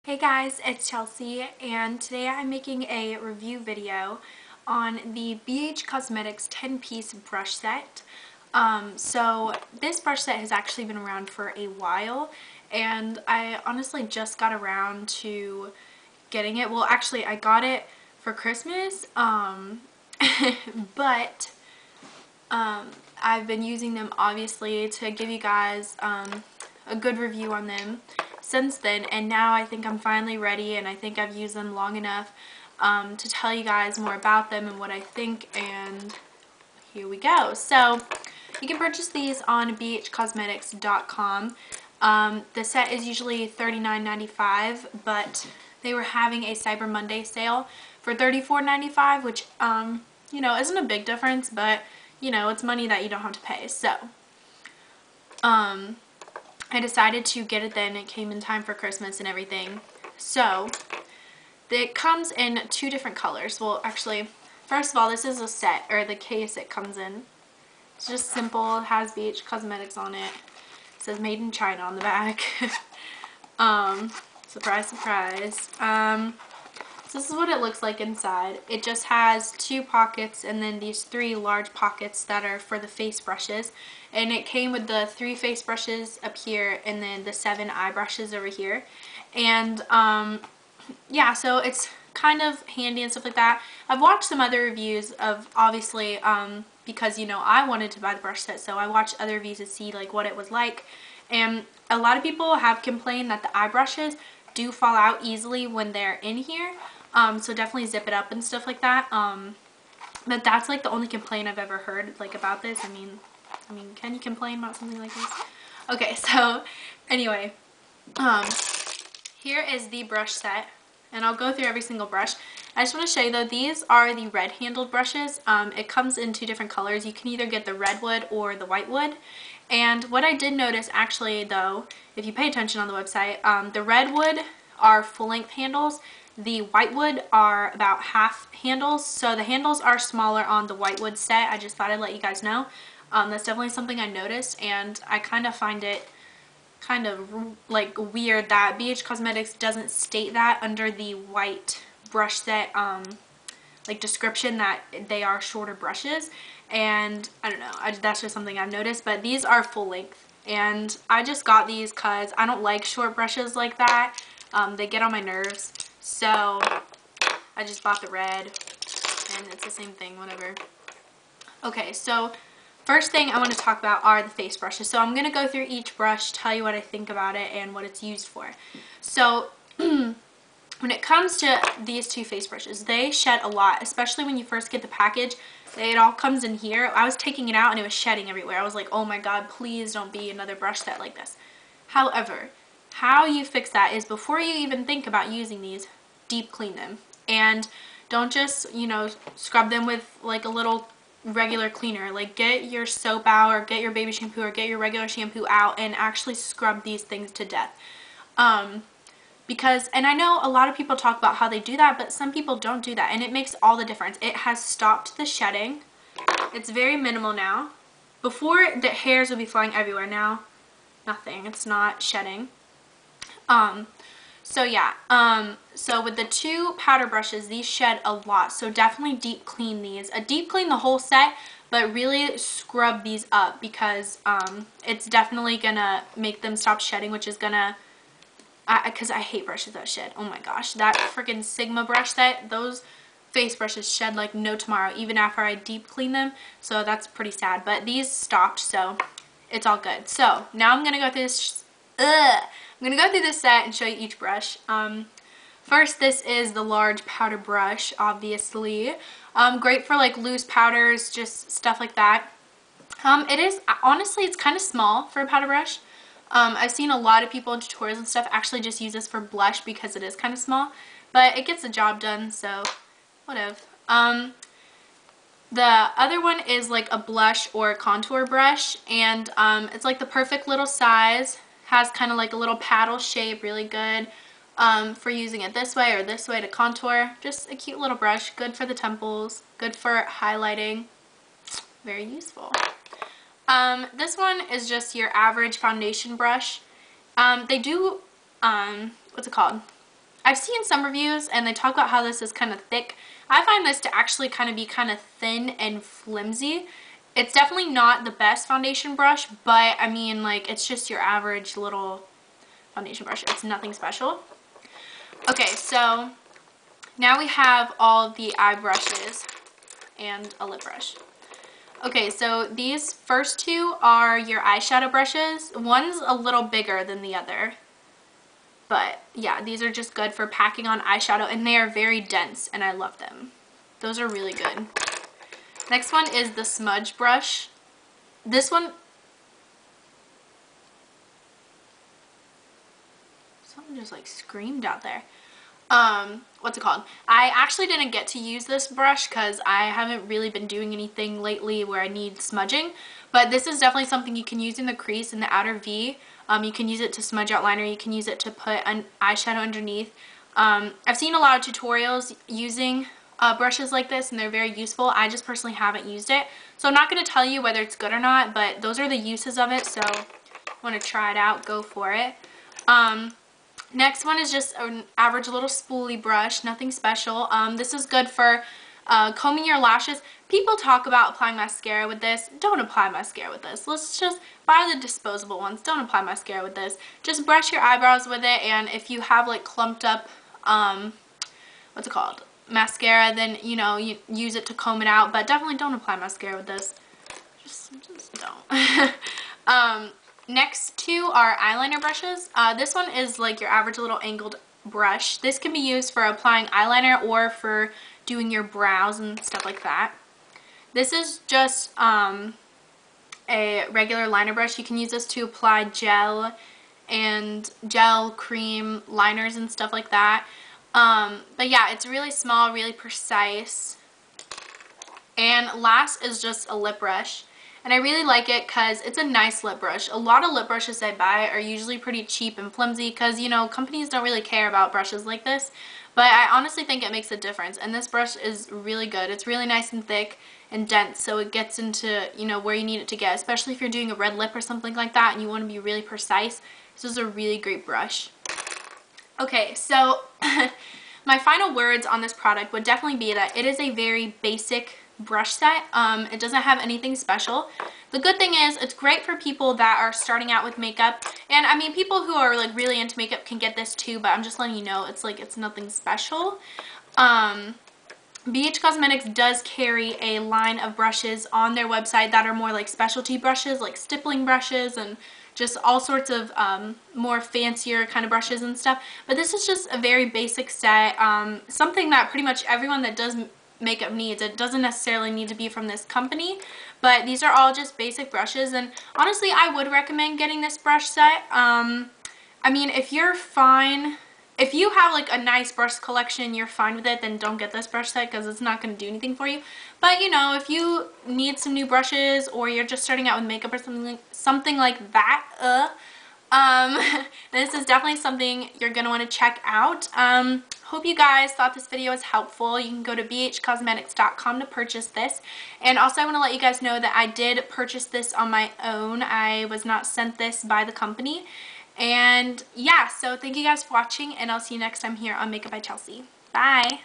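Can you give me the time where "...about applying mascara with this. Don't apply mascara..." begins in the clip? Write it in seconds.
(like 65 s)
380 s.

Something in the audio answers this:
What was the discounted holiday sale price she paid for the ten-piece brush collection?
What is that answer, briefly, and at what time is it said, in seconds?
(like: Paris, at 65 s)
$34.95, at 48 s.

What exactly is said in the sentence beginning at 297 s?
Um, they do, um, what's it called?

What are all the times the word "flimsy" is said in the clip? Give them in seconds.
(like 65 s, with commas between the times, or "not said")
305 s, 432 s.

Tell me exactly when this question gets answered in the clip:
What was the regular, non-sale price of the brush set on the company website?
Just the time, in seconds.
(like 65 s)
43 s.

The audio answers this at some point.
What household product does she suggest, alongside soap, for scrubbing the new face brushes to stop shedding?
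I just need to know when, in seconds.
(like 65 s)
203 s.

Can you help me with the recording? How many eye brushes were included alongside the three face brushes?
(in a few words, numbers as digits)
7.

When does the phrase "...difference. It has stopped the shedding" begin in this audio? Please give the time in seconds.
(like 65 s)
213 s.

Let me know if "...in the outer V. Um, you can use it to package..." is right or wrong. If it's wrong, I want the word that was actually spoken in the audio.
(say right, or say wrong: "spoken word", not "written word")
wrong: "smudge", not "package".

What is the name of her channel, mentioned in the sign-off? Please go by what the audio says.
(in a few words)
Makeup by Chelsey.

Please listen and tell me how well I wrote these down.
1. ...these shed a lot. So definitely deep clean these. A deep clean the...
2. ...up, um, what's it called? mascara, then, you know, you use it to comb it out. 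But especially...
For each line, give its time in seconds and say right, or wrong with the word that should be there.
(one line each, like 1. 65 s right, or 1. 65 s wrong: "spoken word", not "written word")
1. 227 s right
2. 389 s wrong: "definitely", not "especially".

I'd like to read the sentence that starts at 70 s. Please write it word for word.
It says Made in China on the back.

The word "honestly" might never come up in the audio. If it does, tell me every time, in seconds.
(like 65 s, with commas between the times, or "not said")
13 s, 263 s, 436 s, 488 s.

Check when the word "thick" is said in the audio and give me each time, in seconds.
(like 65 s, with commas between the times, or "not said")
302 s, 439 s.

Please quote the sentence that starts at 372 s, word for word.
Um, next one is just an average little spoolie brush, nothing special.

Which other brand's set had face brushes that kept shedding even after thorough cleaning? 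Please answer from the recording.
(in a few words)
Sigma.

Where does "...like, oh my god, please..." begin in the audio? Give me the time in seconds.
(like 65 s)
188 s.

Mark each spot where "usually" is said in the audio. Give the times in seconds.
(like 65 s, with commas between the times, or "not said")
43 s, 431 s.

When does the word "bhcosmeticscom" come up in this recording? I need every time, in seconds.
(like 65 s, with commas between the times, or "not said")
39 s, 513 s.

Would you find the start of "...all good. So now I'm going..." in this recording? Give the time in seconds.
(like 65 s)
249 s.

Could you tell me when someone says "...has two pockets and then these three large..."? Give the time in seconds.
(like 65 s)
79 s.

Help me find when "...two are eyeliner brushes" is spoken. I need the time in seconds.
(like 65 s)
400 s.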